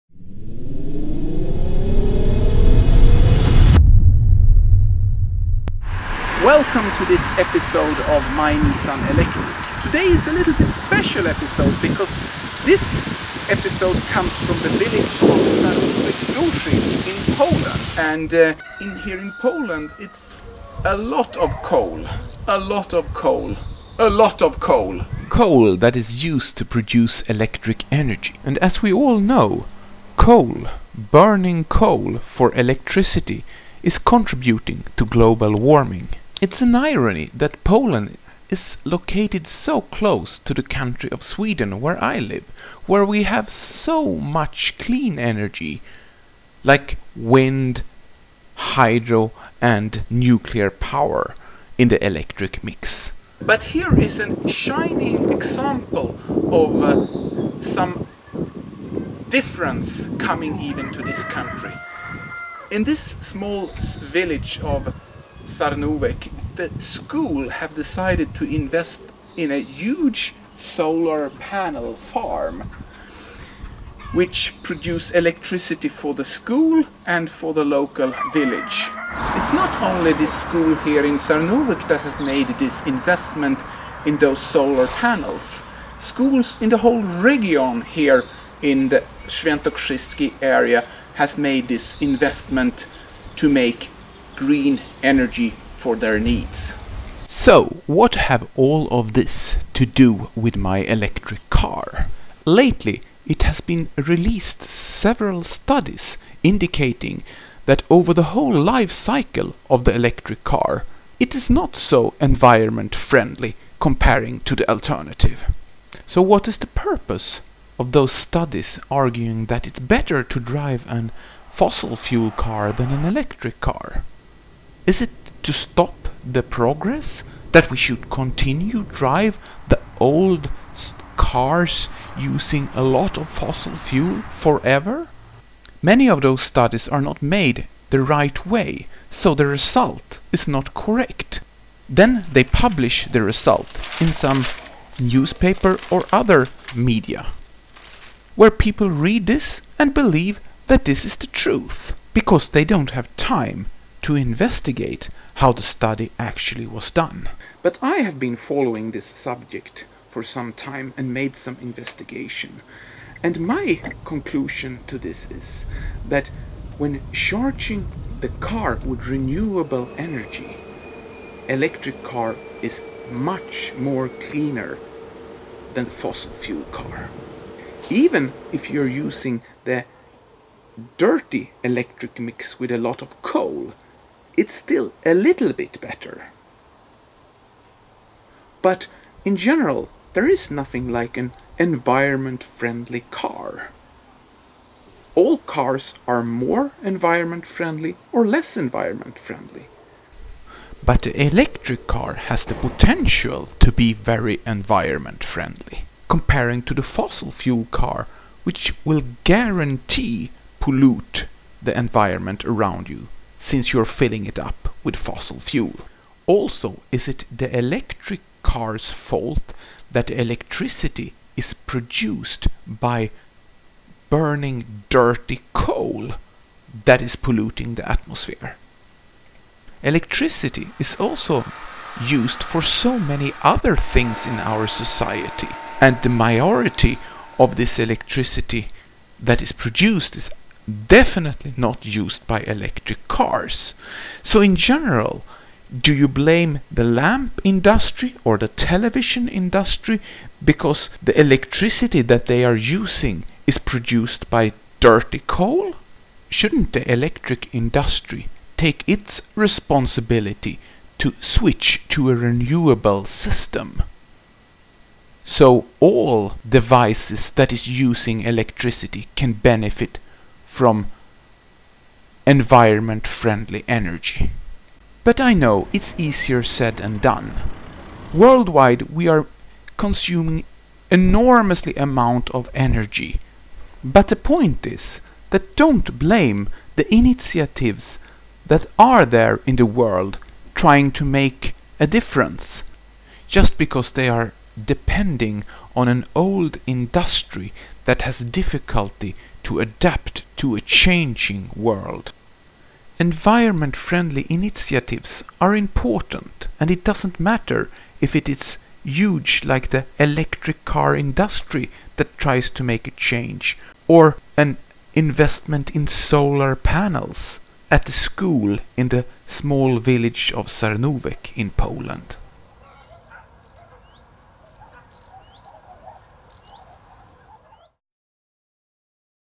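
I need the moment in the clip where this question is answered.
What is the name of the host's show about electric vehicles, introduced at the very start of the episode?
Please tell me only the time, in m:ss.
0:08.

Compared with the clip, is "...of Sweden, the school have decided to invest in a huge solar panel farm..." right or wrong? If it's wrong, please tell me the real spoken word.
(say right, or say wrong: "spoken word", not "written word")
wrong: "Sarnówek", not "Sweden".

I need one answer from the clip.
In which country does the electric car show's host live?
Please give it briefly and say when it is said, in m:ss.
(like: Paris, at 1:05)
Sweden, at 0:41.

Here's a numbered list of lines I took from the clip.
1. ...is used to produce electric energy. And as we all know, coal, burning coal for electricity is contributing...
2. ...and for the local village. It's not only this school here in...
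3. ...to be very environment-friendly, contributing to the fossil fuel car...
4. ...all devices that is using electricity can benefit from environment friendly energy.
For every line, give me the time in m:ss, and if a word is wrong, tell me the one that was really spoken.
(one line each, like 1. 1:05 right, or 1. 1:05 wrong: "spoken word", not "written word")
1. 0:25 right
2. 1:17 right
3. 3:23 wrong: "comparing", not "contributing"
4. 4:25 right.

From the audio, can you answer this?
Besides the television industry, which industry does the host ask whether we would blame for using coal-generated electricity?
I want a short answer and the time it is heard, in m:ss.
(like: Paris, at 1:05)
Lamp industry, at 4:06.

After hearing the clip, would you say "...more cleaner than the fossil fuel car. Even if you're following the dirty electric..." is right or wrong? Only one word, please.
wrong.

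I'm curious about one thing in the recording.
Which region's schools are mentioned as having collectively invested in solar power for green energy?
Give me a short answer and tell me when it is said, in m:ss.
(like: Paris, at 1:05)
Świętokrzyski, at 1:29.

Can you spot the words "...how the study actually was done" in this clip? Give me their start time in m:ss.
2:35.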